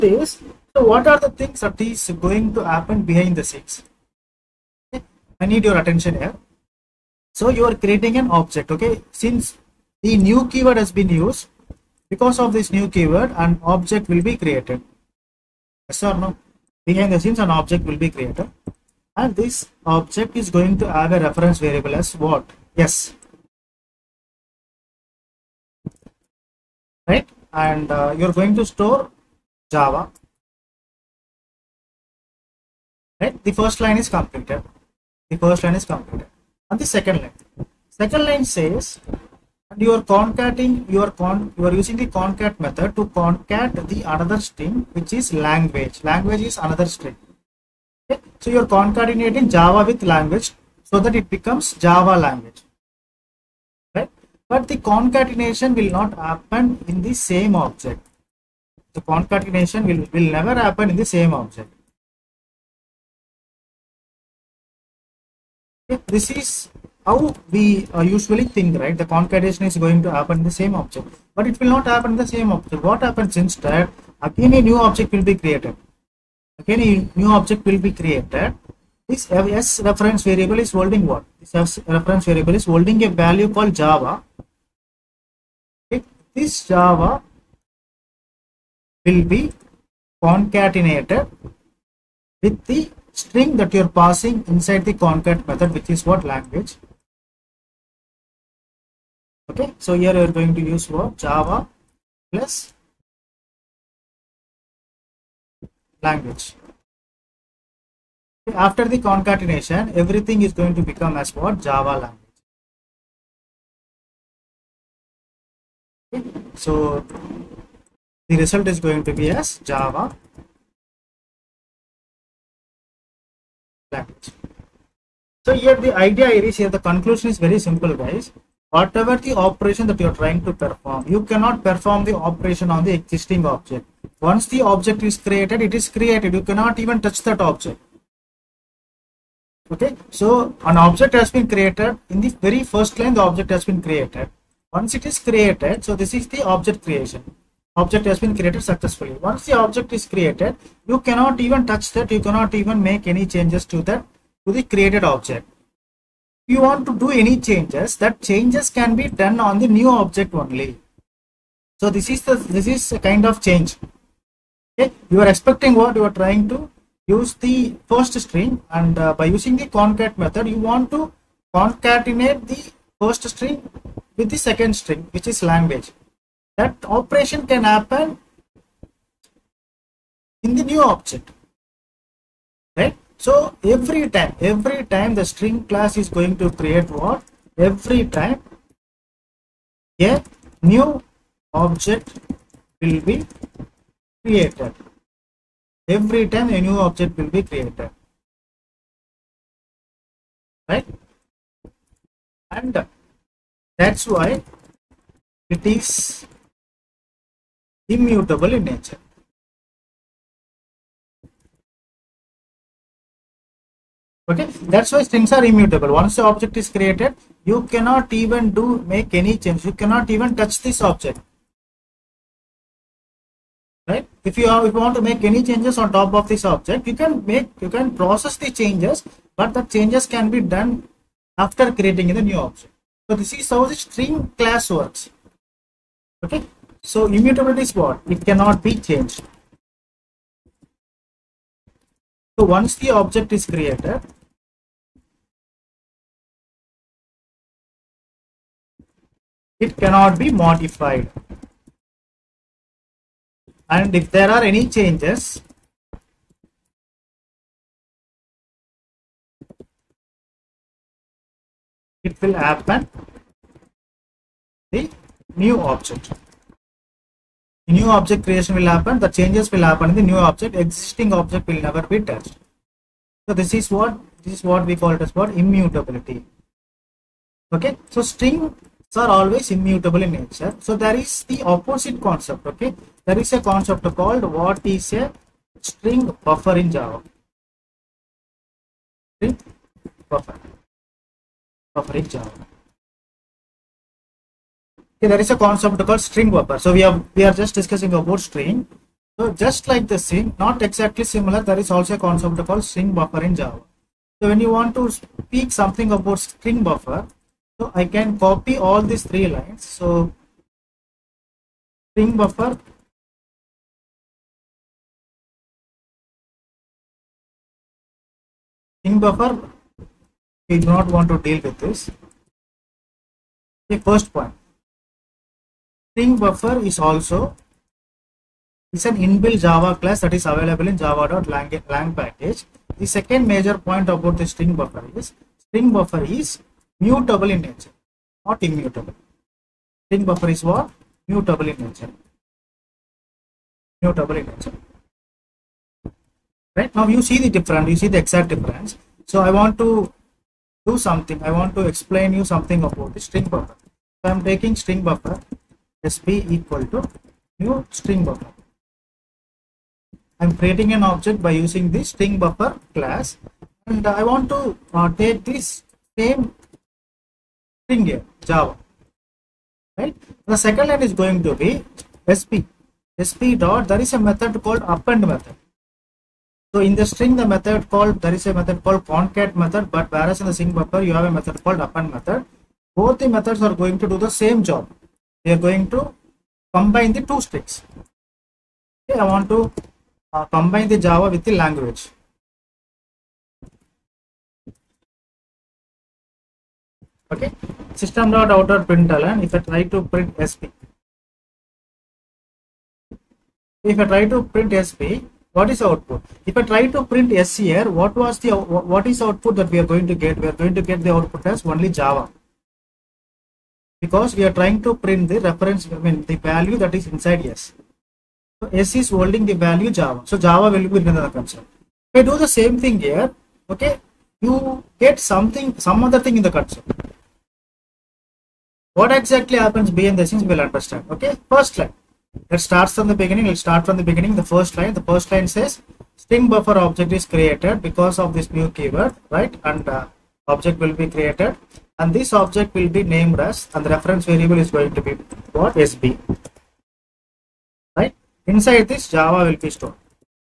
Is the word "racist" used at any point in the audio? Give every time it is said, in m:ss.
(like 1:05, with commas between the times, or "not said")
not said.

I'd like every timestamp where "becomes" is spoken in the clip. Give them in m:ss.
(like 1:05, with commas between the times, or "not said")
0:51, 1:50.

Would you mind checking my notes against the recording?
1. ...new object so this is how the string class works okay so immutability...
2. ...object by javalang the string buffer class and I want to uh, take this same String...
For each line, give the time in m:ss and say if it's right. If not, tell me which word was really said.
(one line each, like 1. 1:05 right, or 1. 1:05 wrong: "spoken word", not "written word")
1. 3:52 right
2. 6:00 wrong: "using", not "javalang".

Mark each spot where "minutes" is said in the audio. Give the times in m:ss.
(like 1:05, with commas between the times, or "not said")
not said.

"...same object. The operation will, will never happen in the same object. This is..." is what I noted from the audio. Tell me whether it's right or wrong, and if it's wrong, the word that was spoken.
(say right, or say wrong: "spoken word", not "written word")
wrong: "concatenation", not "operation".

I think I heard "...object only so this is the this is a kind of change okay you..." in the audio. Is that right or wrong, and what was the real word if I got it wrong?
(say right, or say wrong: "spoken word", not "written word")
right.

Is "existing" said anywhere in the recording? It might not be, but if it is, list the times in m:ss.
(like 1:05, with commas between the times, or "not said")
2:12, 4:30.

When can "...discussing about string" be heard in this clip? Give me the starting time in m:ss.
4:57.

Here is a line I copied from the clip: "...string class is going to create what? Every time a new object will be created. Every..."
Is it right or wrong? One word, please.
right.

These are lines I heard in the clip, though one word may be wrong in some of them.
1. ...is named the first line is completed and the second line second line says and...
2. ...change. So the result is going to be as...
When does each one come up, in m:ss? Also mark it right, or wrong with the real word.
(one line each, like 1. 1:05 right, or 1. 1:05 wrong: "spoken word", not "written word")
1. 0:33 wrong: "completed", not "named"
2. 1:56 wrong: "language", not "change".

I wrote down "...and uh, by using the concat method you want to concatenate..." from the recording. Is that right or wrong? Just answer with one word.
right.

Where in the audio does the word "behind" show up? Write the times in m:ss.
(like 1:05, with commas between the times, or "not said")
0:03, 0:16, 7:09.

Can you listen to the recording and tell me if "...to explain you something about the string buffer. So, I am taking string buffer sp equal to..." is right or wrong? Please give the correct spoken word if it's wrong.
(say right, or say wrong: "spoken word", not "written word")
right.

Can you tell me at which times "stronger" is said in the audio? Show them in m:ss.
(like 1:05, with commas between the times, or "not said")
not said.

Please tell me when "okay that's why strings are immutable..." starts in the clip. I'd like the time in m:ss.
3:34.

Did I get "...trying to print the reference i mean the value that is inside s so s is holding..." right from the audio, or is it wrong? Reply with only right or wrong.
right.